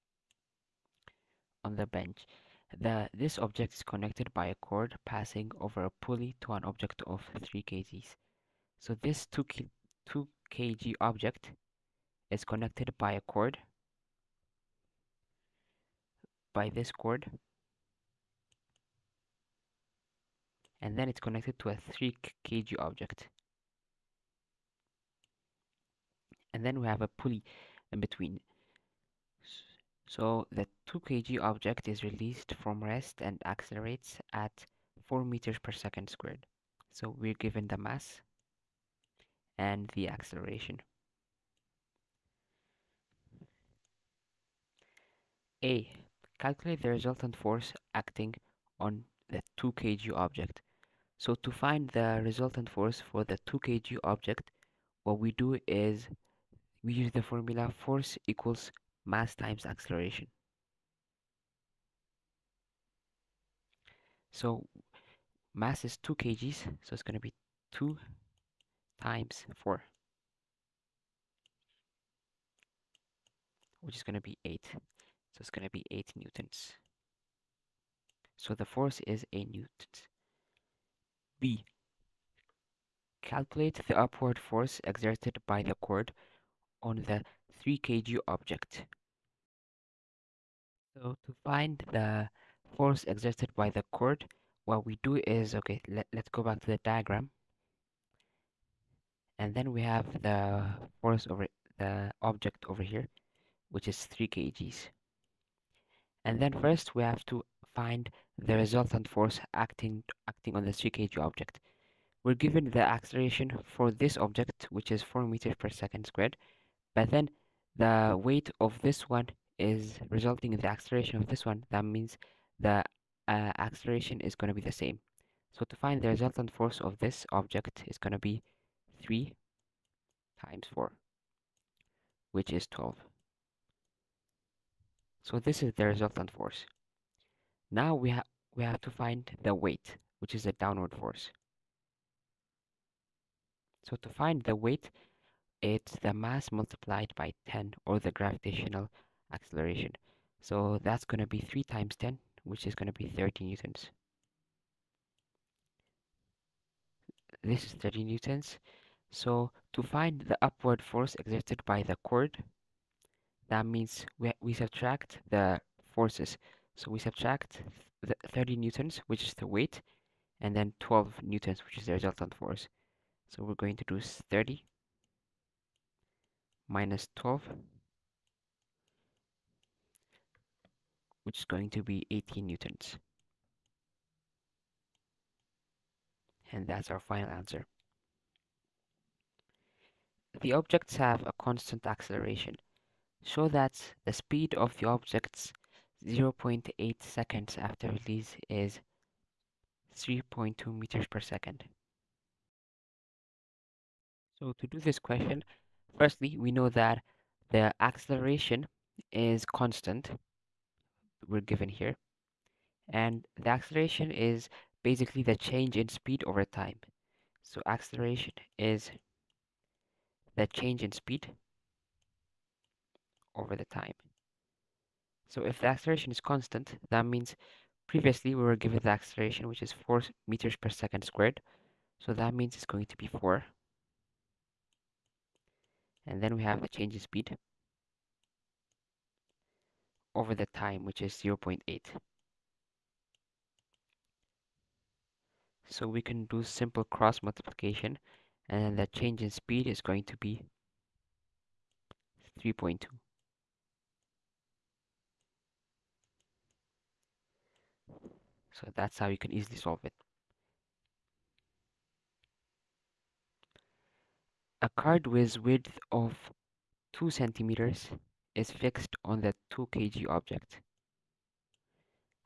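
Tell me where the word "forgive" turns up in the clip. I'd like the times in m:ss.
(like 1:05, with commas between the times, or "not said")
not said.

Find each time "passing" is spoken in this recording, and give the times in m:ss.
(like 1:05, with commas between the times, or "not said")
0:05.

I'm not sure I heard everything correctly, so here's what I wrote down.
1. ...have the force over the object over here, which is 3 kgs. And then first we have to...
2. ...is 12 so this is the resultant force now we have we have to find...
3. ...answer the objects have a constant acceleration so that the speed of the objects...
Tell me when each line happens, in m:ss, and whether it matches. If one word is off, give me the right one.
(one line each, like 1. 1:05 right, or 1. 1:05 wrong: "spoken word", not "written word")
1. 1:39 right
2. 2:12 right
3. 3:07 right.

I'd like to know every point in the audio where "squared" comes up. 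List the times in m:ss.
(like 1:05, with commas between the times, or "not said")
0:36, 1:56, 3:51.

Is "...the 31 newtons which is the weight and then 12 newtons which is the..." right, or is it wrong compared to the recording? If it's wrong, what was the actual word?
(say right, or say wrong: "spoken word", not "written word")
wrong: "30", not "31".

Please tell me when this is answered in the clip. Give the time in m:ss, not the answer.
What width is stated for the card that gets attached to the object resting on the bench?
4:26.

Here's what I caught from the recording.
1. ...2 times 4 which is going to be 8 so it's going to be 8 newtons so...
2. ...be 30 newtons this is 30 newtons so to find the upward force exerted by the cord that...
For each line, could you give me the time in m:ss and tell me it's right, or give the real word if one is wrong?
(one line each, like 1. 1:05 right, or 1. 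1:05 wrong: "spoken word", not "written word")
1. 1:07 right
2. 2:32 right.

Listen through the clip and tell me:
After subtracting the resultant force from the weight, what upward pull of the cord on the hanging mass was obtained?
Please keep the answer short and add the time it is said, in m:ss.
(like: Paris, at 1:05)
18 newtons, at 3:02.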